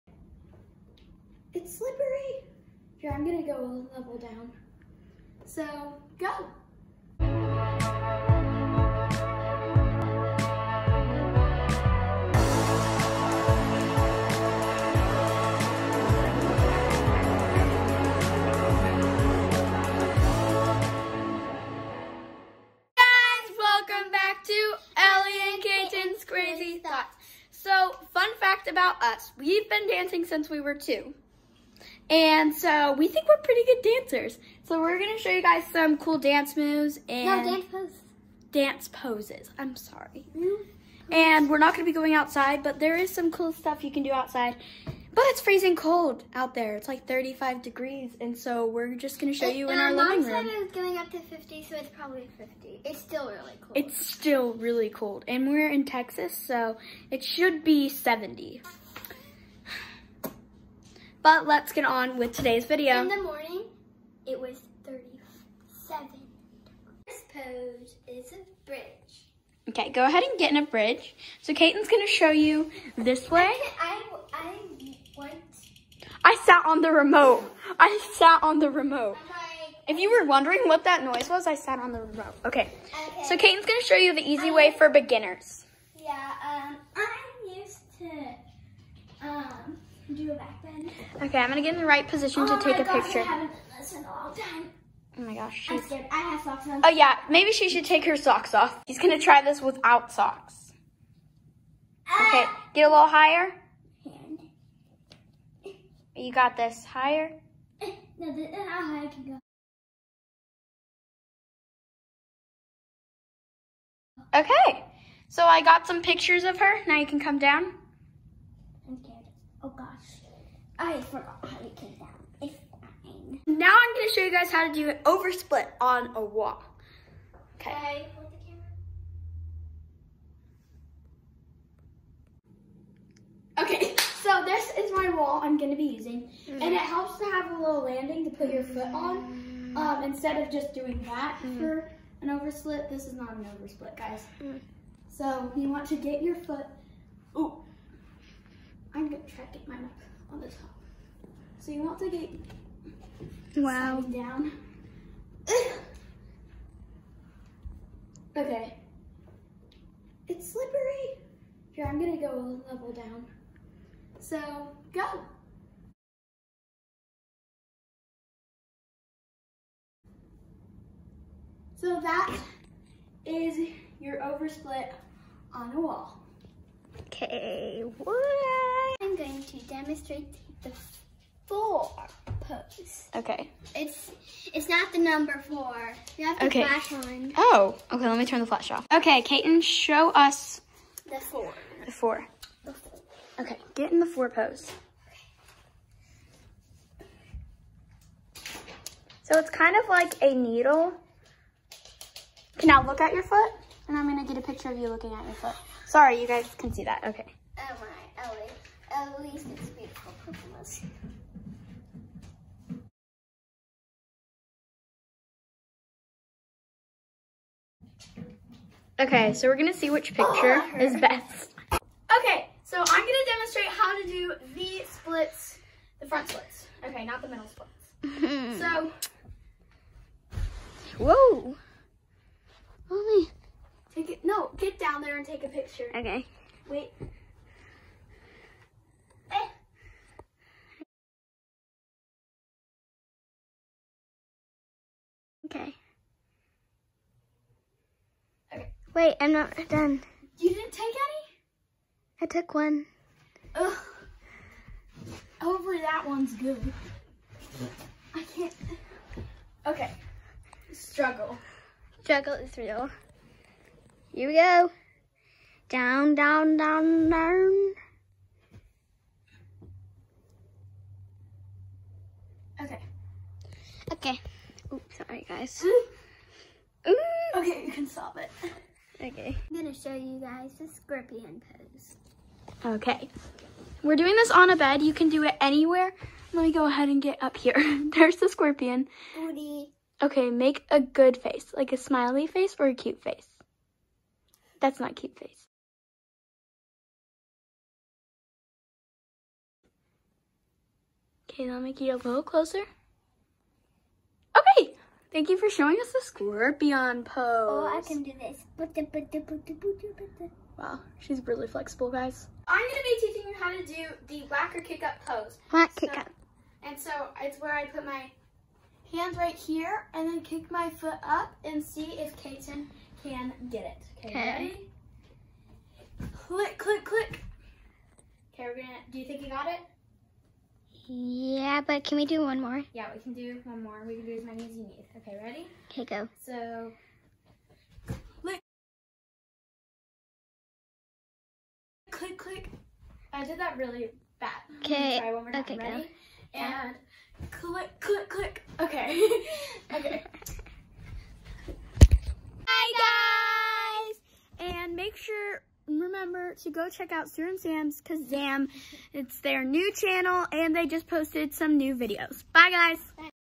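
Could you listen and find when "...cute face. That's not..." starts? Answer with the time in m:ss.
4:52.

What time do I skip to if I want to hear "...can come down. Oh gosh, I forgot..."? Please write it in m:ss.
1:57.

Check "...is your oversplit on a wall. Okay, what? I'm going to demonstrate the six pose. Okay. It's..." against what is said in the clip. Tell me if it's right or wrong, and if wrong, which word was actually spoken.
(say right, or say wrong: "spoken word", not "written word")
wrong: "four", not "six".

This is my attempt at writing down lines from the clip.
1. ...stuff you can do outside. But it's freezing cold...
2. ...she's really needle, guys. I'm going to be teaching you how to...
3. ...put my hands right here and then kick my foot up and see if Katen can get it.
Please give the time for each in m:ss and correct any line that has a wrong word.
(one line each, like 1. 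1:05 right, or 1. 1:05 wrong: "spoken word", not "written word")
1. 0:43 right
2. 5:10 wrong: "flexible", not "needle"
3. 5:17 right.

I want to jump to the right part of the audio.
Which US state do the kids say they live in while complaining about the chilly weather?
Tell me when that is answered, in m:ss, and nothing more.
0:55.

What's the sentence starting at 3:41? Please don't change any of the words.
Okay, so I'm gonna demonstrate how to do the splits, the front splits.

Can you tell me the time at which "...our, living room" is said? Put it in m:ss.
0:49.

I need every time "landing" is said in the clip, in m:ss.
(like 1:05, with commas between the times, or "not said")
2:17.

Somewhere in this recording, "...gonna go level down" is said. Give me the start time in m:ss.
2:41.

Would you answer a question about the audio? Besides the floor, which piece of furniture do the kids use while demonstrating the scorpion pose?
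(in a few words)
A bed.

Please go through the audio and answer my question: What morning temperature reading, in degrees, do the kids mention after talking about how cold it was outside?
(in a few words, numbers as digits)
37.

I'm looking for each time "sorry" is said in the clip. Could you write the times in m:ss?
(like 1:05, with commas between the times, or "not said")
0:39, 3:25, 4:34.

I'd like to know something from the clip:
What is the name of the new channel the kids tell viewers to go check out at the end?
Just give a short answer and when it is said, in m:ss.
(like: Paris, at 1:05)
Sue and Sam's Kazam, at 5:57.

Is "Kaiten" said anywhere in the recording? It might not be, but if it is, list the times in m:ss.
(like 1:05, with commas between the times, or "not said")
1:11, 1:23, 3:09.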